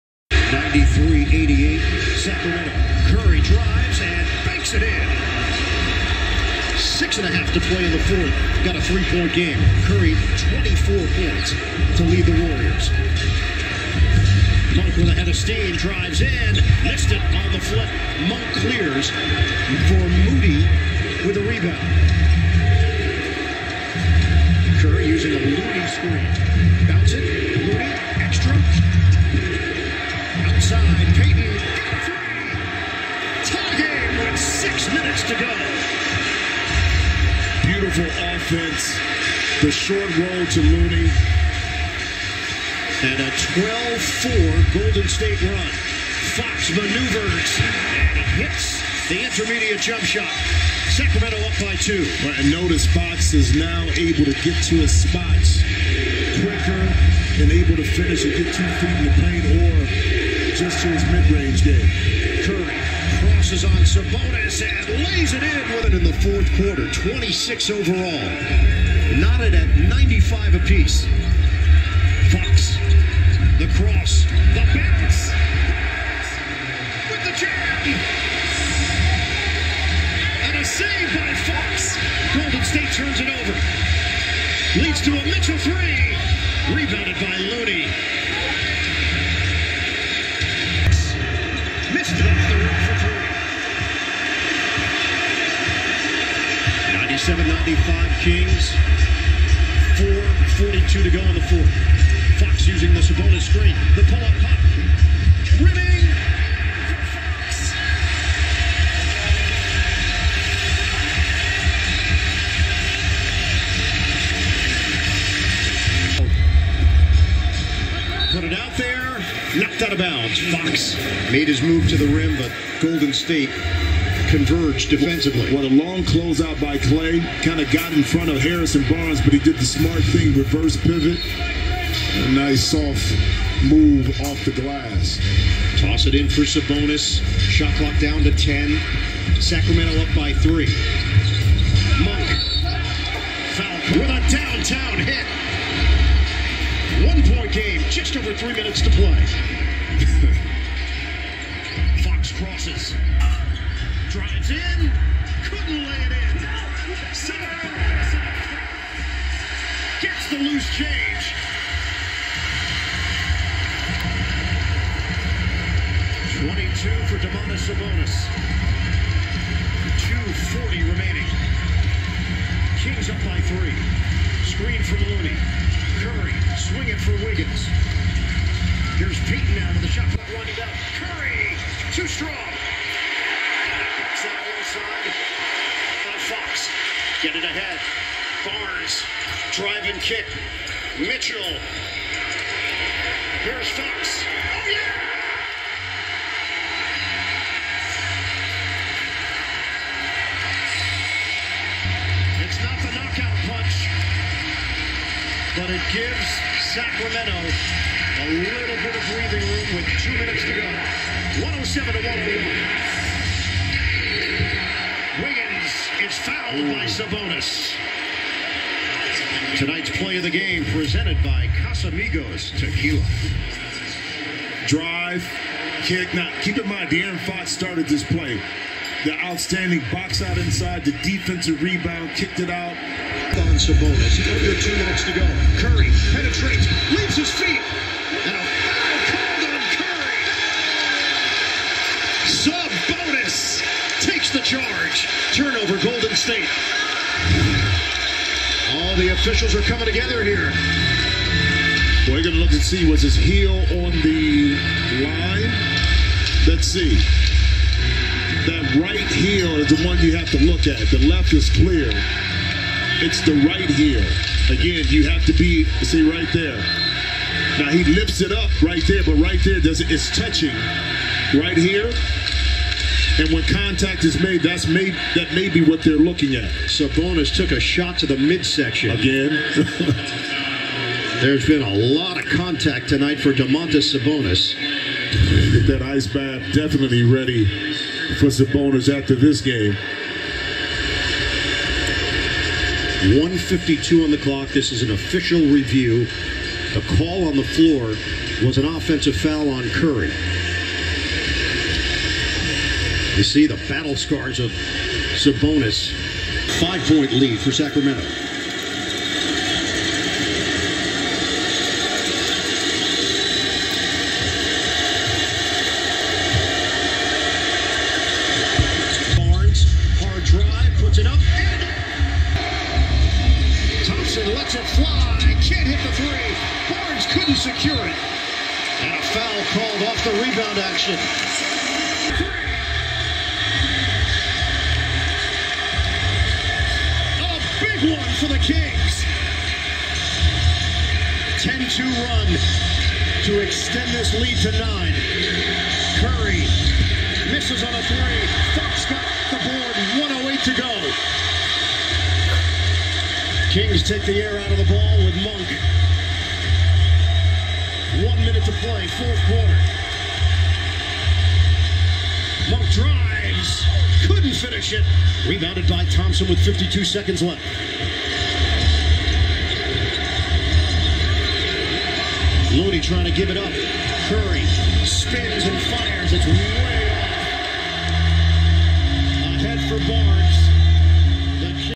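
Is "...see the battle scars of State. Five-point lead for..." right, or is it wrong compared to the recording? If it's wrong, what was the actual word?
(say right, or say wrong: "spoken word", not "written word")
wrong: "Sabonis", not "State".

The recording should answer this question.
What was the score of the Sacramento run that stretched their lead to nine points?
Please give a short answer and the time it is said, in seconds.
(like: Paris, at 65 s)
10-2, at 341 s.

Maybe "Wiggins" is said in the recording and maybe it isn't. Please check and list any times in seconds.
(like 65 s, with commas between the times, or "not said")
177 s, 215 s.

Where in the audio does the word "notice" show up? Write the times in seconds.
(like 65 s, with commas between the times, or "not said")
52 s.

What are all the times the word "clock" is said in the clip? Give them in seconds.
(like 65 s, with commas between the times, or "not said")
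137 s, 294 s.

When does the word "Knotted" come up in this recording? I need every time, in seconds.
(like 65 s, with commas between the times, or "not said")
69 s.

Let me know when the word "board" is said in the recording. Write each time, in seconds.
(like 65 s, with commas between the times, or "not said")
349 s.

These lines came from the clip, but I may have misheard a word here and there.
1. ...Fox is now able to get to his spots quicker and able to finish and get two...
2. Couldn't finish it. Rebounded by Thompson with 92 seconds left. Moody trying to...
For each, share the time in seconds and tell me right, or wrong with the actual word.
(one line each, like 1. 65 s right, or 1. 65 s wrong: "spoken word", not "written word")
1. 52 s right
2. 364 s wrong: "52", not "92".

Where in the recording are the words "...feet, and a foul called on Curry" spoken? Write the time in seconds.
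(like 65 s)
237 s.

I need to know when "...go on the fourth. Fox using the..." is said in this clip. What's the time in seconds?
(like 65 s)
101 s.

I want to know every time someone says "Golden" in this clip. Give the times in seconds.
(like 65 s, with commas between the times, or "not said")
44 s, 82 s, 122 s, 245 s.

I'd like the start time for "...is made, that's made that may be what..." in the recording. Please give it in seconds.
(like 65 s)
274 s.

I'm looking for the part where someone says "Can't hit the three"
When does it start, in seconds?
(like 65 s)
325 s.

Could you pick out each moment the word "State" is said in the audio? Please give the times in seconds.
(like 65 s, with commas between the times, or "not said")
45 s, 82 s, 123 s, 246 s.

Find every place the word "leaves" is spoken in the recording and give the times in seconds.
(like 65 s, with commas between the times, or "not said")
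236 s.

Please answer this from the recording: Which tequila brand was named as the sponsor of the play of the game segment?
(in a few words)
Casamigos Tequila.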